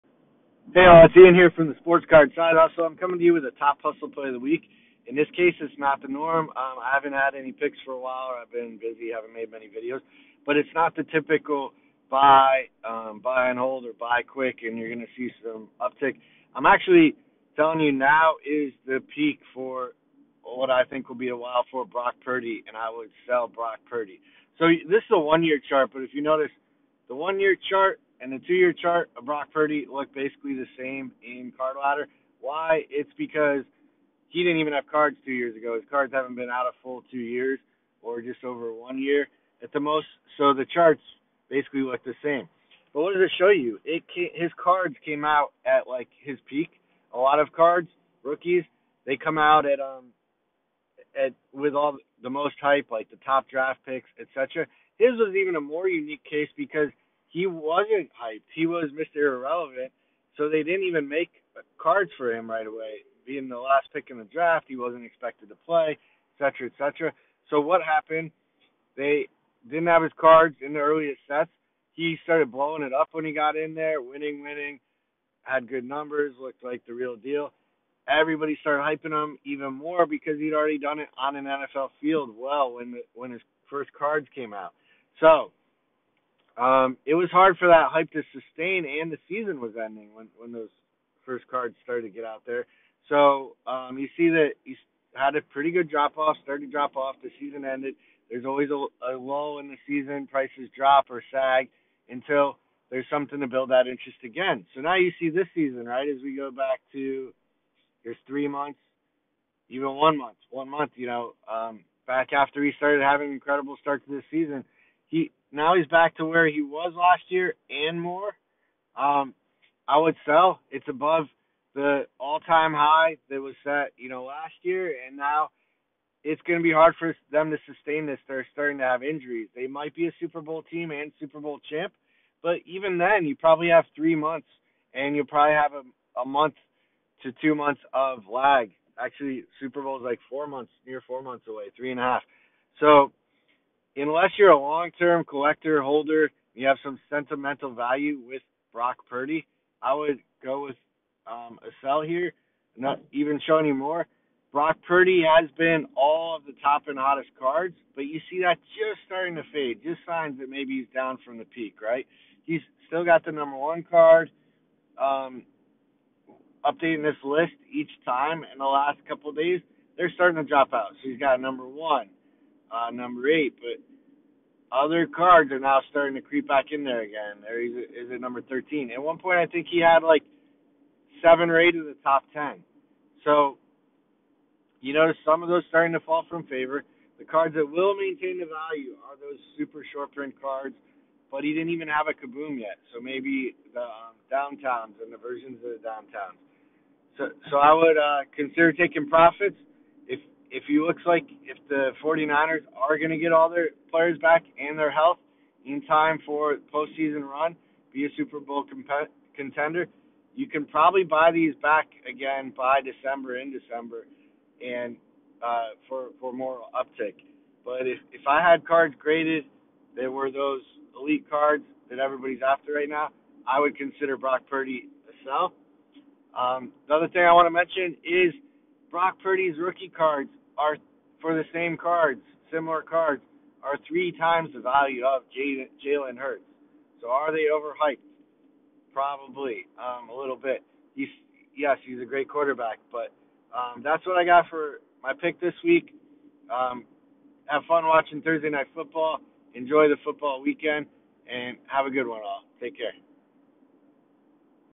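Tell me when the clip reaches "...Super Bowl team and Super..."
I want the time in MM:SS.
02:10.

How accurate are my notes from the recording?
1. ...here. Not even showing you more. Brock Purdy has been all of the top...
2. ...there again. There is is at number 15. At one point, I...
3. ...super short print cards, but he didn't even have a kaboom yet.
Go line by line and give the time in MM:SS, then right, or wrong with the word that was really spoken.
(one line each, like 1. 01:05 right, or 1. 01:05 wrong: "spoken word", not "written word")
1. 02:32 right
2. 02:56 wrong: "13", not "15"
3. 03:09 right.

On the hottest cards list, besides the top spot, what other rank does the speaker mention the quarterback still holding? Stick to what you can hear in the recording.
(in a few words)
8.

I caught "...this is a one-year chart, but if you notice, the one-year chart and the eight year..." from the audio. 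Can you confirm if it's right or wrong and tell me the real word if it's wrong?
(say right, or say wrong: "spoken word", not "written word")
wrong: "two", not "eight".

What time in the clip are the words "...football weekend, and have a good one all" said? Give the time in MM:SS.
04:10.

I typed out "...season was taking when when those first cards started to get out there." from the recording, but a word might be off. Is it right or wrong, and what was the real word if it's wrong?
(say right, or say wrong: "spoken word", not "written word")
wrong: "ending", not "taking".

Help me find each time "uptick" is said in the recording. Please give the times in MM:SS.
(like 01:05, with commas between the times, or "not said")
00:15, 03:36.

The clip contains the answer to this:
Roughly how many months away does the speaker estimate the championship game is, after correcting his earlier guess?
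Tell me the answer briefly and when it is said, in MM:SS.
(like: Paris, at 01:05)
3 and a half, at 02:21.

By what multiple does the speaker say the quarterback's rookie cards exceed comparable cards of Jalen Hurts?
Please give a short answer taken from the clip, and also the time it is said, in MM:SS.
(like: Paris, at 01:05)
3 times, at 03:53.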